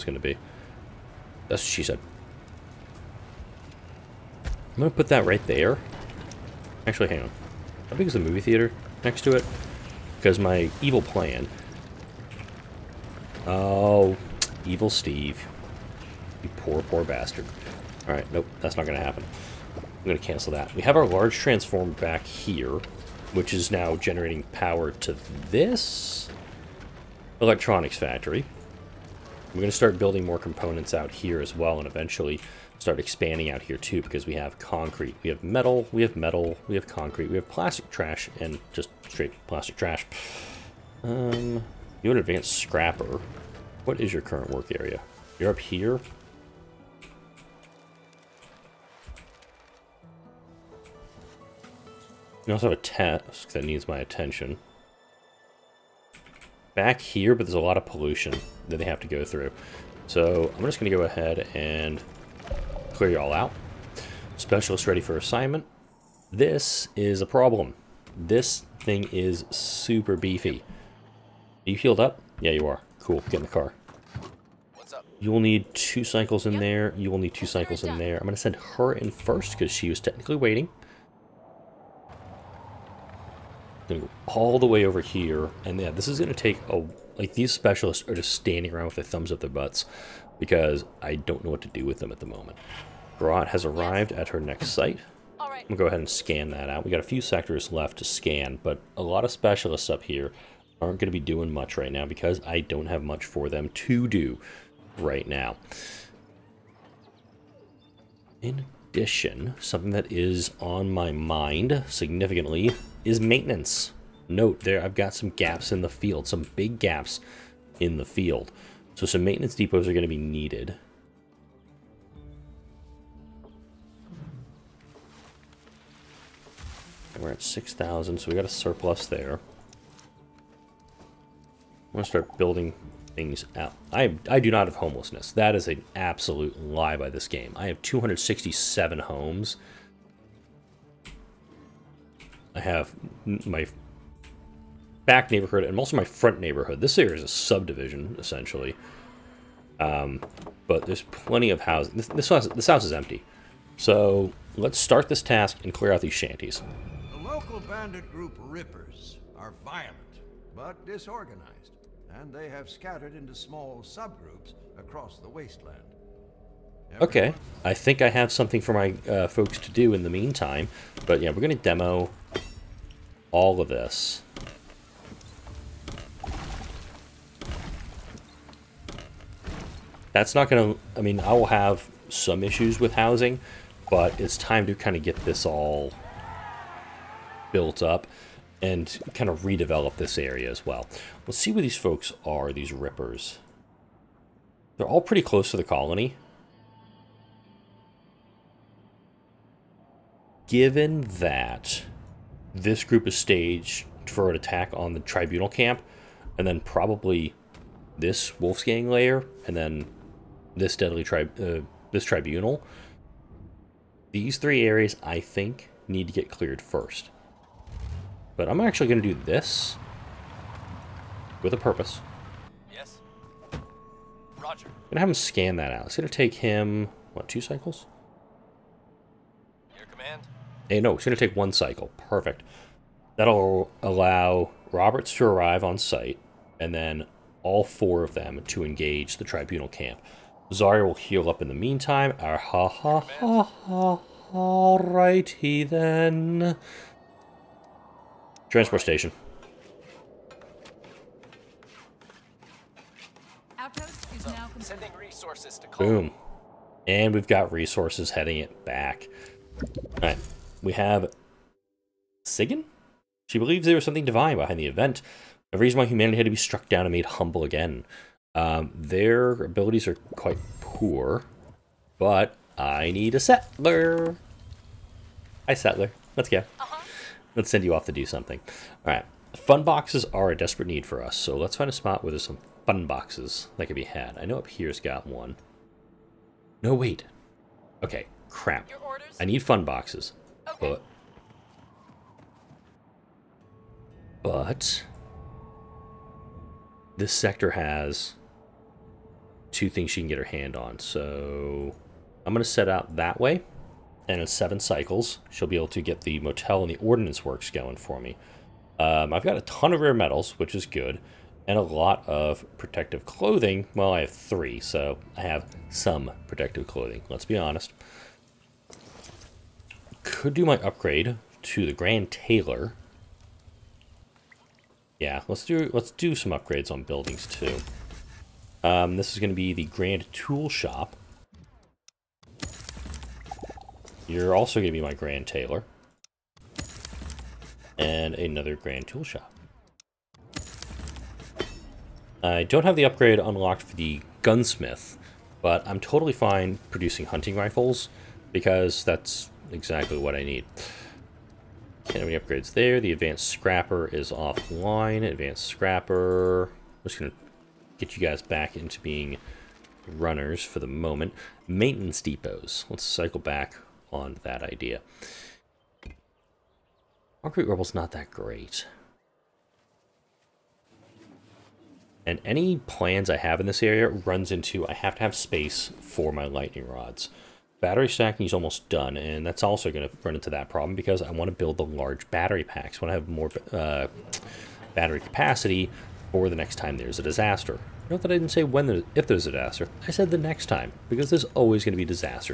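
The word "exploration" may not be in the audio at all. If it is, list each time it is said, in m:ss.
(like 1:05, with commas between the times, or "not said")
not said.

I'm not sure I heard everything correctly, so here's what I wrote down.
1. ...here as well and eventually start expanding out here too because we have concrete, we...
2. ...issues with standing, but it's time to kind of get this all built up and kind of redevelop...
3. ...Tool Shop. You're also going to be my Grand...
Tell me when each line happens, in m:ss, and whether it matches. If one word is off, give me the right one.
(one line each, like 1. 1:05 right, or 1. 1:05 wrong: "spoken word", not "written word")
1. 0:31 right
2. 3:02 wrong: "housing", not "standing"
3. 5:30 right.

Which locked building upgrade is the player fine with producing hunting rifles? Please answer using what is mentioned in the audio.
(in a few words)
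Gunsmith.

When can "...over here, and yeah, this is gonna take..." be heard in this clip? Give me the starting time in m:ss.
1:24.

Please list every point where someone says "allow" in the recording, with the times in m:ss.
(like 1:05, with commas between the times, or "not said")
3:53.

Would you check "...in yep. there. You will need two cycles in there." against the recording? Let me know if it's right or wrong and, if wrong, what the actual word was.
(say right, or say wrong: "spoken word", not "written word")
right.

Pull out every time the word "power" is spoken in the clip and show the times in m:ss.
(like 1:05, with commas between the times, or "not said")
0:24.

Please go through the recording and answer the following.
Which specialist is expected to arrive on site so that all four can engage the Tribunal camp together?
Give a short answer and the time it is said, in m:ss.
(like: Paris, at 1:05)
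Roberts, at 3:54.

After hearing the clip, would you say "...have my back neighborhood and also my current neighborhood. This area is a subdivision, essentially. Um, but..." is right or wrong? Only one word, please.
wrong.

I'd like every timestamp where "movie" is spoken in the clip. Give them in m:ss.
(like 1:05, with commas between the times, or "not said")
0:08.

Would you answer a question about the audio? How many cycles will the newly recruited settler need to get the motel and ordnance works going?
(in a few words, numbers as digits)
7.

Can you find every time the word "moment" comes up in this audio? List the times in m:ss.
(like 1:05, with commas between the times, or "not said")
1:32, 6:00.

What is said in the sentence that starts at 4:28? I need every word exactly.
Um, their abilities are quite poor, but I need a settler.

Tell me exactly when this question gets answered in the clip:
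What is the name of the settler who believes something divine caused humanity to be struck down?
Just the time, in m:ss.
4:22.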